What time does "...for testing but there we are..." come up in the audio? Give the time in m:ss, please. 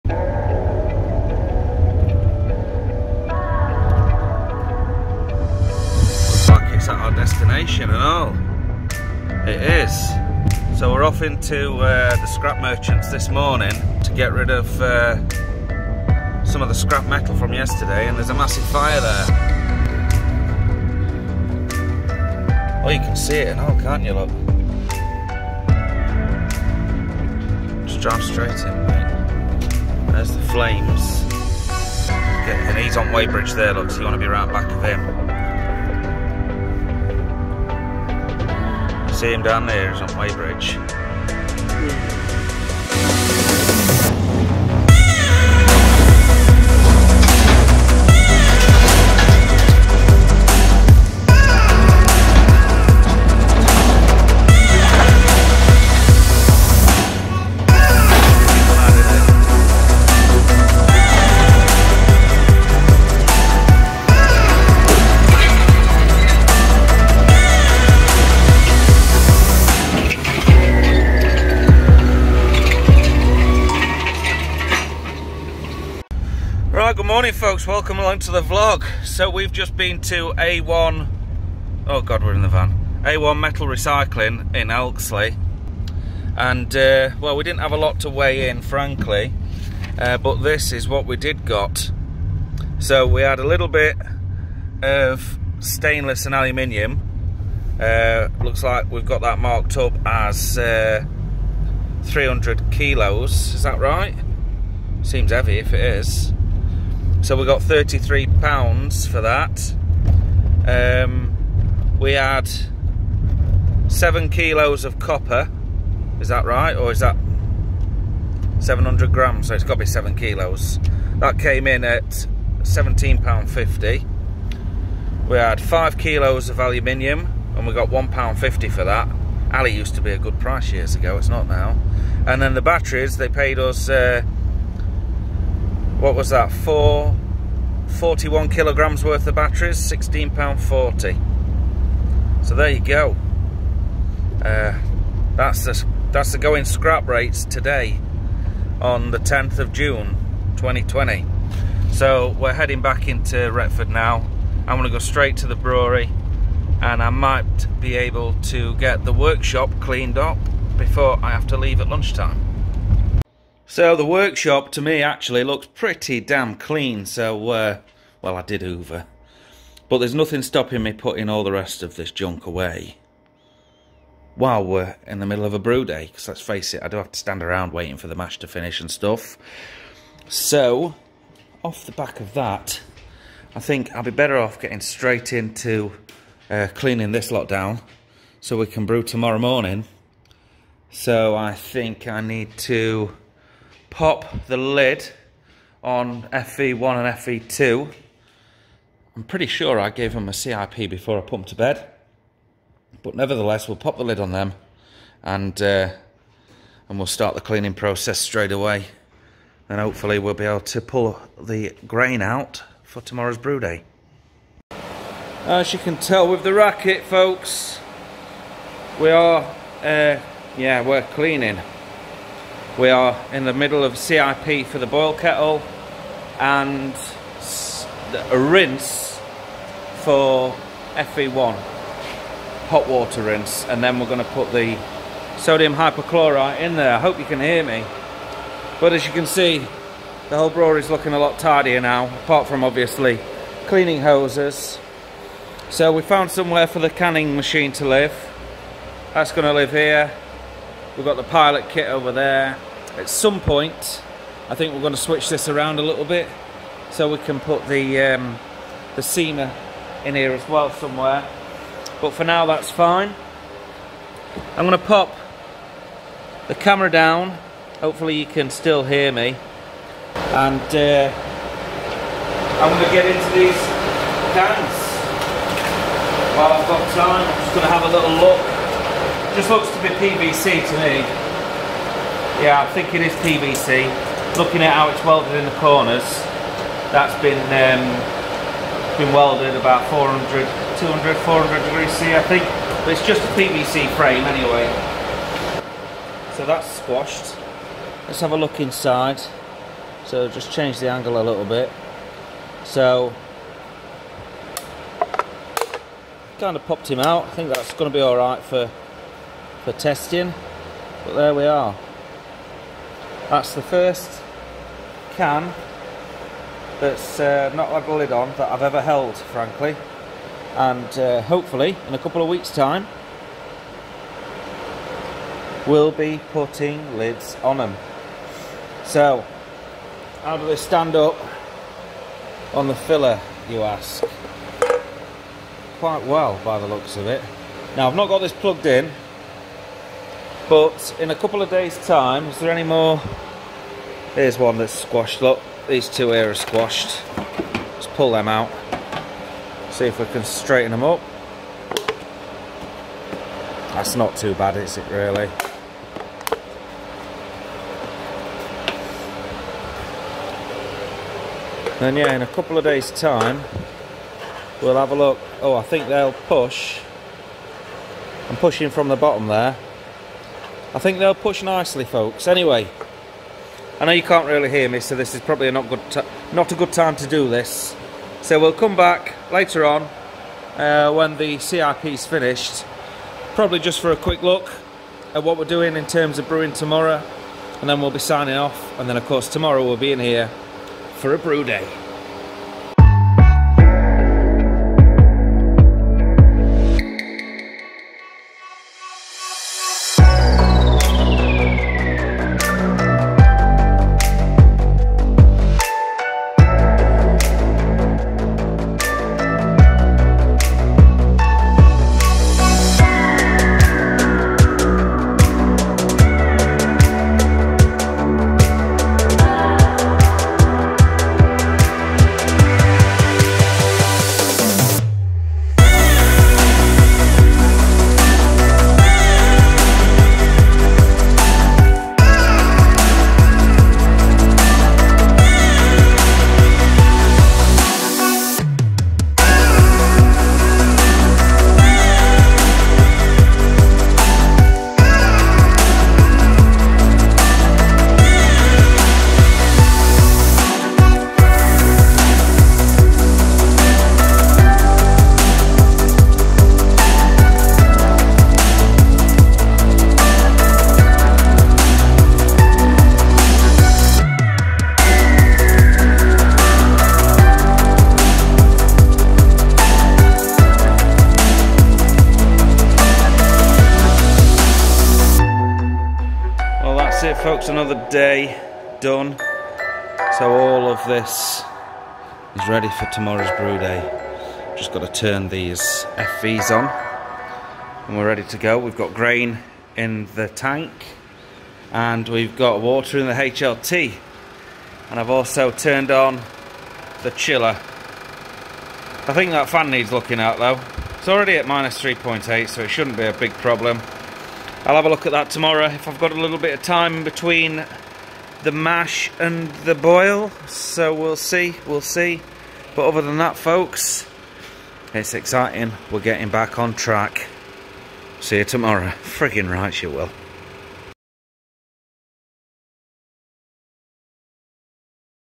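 5:09.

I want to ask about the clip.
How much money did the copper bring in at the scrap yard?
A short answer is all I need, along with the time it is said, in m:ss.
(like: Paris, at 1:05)
£17.50, at 2:02.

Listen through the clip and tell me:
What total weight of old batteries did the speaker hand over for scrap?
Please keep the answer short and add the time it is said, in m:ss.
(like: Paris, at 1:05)
41 kilograms, at 2:17.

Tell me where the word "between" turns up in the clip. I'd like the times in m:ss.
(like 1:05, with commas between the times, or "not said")
8:27.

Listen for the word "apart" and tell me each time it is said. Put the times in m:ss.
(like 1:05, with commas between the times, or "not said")
4:02.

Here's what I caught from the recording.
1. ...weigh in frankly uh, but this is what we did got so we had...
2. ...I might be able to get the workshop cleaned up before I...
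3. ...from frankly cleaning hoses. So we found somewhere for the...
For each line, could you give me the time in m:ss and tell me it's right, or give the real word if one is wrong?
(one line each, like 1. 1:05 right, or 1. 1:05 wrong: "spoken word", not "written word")
1. 1:28 right
2. 2:37 right
3. 4:02 wrong: "obviously", not "frankly".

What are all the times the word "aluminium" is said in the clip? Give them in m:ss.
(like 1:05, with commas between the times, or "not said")
1:36, 2:06.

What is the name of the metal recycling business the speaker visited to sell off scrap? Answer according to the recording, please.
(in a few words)
A1 Metal Recycling.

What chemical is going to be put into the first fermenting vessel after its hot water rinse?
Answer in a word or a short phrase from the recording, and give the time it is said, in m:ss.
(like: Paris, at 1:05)
sodium hypochlorite, at 3:55.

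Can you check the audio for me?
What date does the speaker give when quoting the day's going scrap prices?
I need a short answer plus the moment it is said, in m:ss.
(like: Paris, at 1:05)
10 June 2020, at 2:29.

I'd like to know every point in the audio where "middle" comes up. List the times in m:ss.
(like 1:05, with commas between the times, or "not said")
2:55, 3:43.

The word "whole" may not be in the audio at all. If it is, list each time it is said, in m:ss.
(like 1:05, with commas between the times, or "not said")
4:00.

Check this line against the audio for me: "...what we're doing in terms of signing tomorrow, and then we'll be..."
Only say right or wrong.
wrong.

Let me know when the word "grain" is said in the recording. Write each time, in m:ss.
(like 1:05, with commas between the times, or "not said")
3:31, 8:08.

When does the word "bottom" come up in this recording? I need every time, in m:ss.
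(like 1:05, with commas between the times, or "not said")
6:08.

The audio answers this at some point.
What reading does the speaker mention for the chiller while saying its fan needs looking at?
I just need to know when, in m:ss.
8:21.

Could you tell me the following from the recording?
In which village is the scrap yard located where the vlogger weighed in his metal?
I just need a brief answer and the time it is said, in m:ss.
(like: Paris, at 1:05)
Elkesley, at 1:24.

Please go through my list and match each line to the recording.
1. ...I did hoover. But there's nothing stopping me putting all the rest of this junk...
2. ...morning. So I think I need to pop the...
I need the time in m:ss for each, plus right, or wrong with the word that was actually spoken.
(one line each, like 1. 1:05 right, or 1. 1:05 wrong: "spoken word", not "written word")
1. 2:48 right
2. 3:09 right.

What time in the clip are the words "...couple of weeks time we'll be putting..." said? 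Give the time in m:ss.
5:21.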